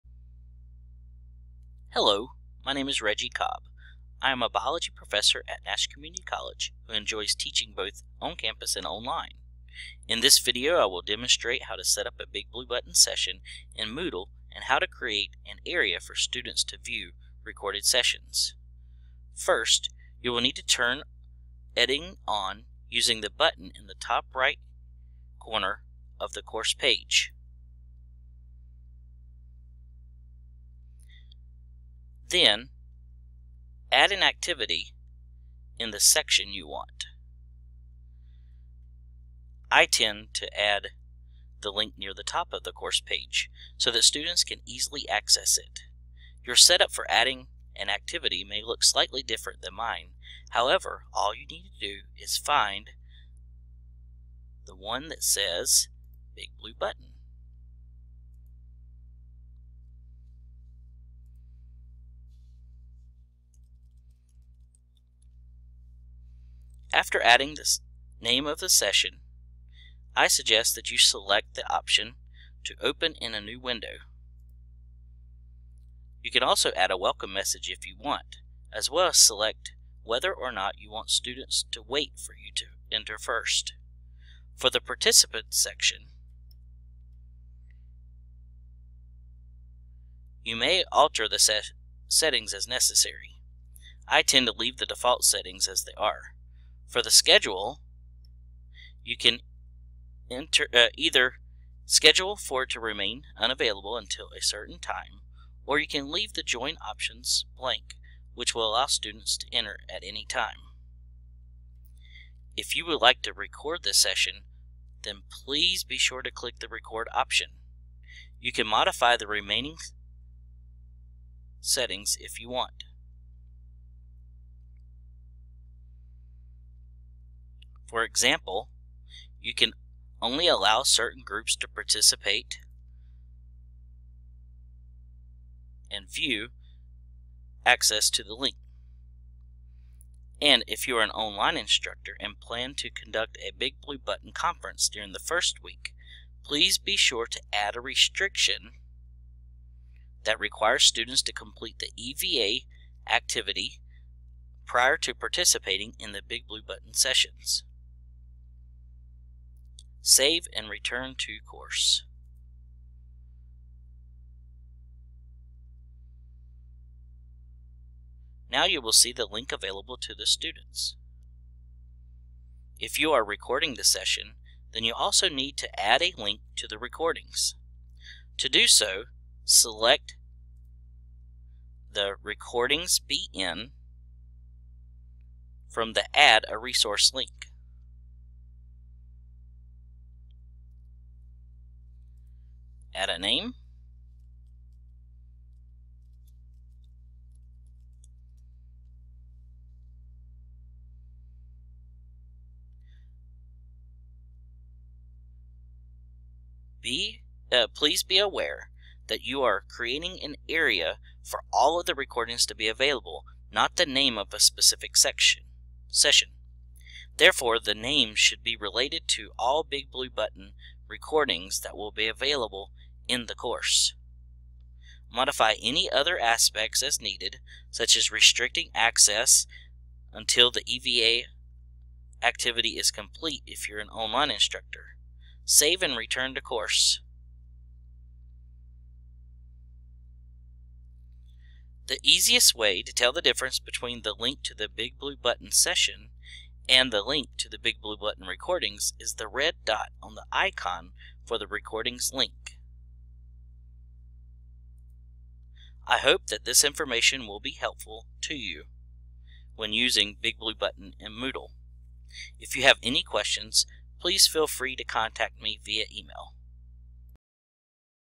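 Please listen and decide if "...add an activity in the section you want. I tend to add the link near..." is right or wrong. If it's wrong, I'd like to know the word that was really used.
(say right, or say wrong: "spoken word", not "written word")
right.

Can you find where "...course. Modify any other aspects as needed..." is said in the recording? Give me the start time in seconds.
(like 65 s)
223 s.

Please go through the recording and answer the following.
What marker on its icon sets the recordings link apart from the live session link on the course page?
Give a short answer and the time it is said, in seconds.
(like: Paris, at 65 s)
red dot, at 249 s.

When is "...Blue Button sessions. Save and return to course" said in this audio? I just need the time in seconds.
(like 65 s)
156 s.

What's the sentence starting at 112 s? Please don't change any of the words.
If you would like to record this session, then please be sure to click the record option.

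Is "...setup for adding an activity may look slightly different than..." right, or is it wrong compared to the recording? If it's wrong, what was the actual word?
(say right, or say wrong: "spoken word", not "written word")
right.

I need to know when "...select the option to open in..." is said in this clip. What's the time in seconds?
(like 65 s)
70 s.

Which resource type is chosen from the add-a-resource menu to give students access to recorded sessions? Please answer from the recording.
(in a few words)
Recordings BN.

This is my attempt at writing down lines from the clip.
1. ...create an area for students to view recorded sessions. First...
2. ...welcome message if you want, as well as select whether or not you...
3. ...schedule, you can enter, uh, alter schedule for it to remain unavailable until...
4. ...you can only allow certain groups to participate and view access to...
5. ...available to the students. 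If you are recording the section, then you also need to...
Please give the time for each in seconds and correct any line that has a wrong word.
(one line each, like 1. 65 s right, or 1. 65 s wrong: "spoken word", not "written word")
1. 14 s right
2. 76 s right
3. 97 s wrong: "either", not "alter"
4. 129 s right
5. 169 s wrong: "session", not "section".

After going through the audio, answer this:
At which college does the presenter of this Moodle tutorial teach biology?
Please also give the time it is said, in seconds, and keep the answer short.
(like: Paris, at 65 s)
Nash Community College, at 5 s.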